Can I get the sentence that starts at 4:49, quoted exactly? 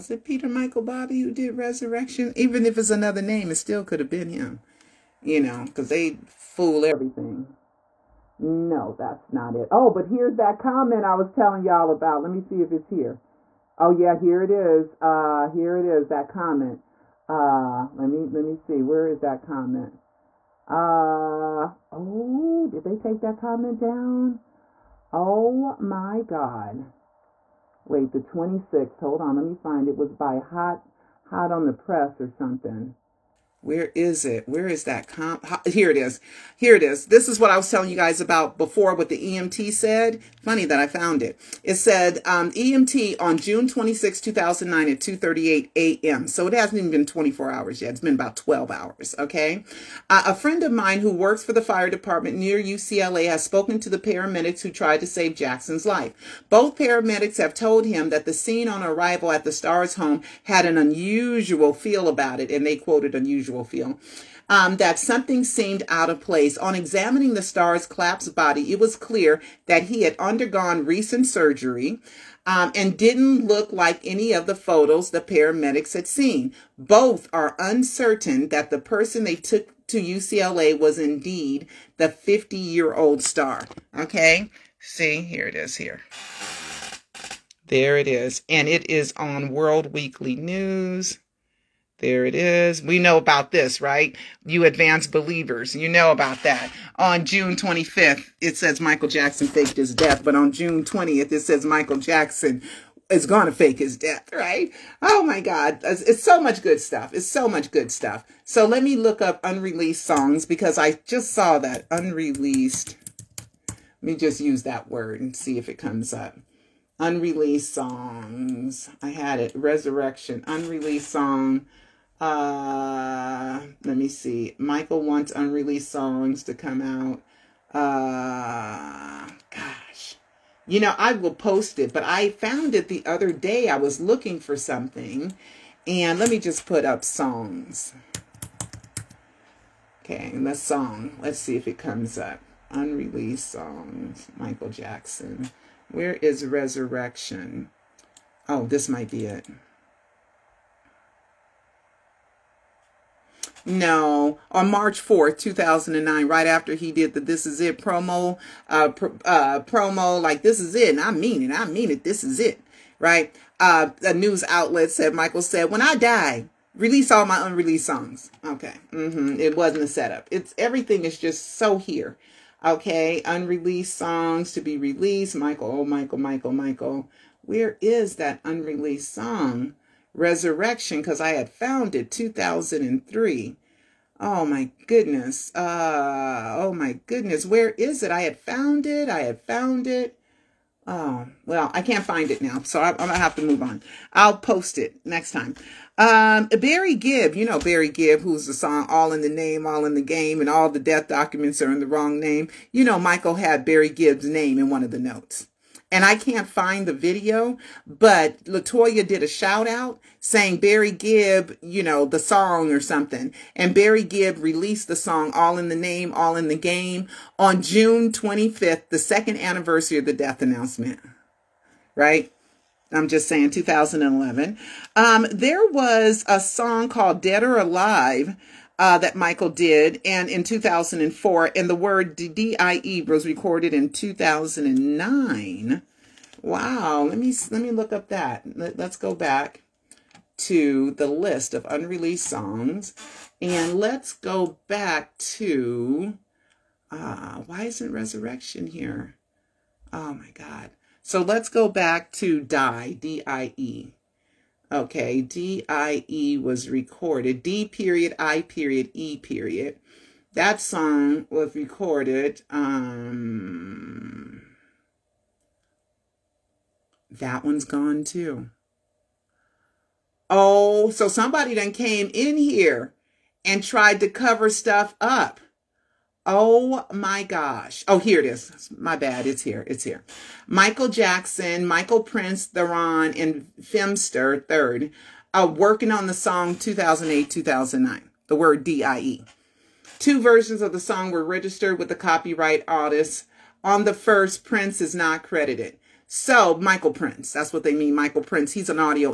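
Two versions of the song were registered with the copyright artist.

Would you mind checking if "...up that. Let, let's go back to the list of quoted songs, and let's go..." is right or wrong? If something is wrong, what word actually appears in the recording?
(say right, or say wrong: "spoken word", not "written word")
wrong: "unreleased", not "quoted".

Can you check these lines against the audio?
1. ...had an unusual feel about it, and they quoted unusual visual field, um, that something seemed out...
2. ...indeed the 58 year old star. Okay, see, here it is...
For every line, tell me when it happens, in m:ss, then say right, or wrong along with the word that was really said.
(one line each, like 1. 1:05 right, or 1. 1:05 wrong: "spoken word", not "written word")
1. 1:00 right
2. 1:20 wrong: "50", not "58".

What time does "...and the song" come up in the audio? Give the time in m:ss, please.
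2:20.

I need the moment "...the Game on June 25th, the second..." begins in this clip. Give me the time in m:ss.
3:36.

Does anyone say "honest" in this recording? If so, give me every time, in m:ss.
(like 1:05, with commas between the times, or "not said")
not said.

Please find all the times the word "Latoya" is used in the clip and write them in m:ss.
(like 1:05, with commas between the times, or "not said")
3:28.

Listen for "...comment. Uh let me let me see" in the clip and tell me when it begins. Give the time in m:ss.
0:16.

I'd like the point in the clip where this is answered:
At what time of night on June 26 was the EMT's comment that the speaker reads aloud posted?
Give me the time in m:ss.
0:45.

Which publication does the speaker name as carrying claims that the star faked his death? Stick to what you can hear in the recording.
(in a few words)
World Weekly News.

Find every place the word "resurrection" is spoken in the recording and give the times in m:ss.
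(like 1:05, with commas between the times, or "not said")
0:01, 1:59, 2:26, 3:00, 4:07.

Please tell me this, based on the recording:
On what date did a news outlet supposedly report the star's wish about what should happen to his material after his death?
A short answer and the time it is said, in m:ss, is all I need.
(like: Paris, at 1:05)
March 4, 2009, at 2:34.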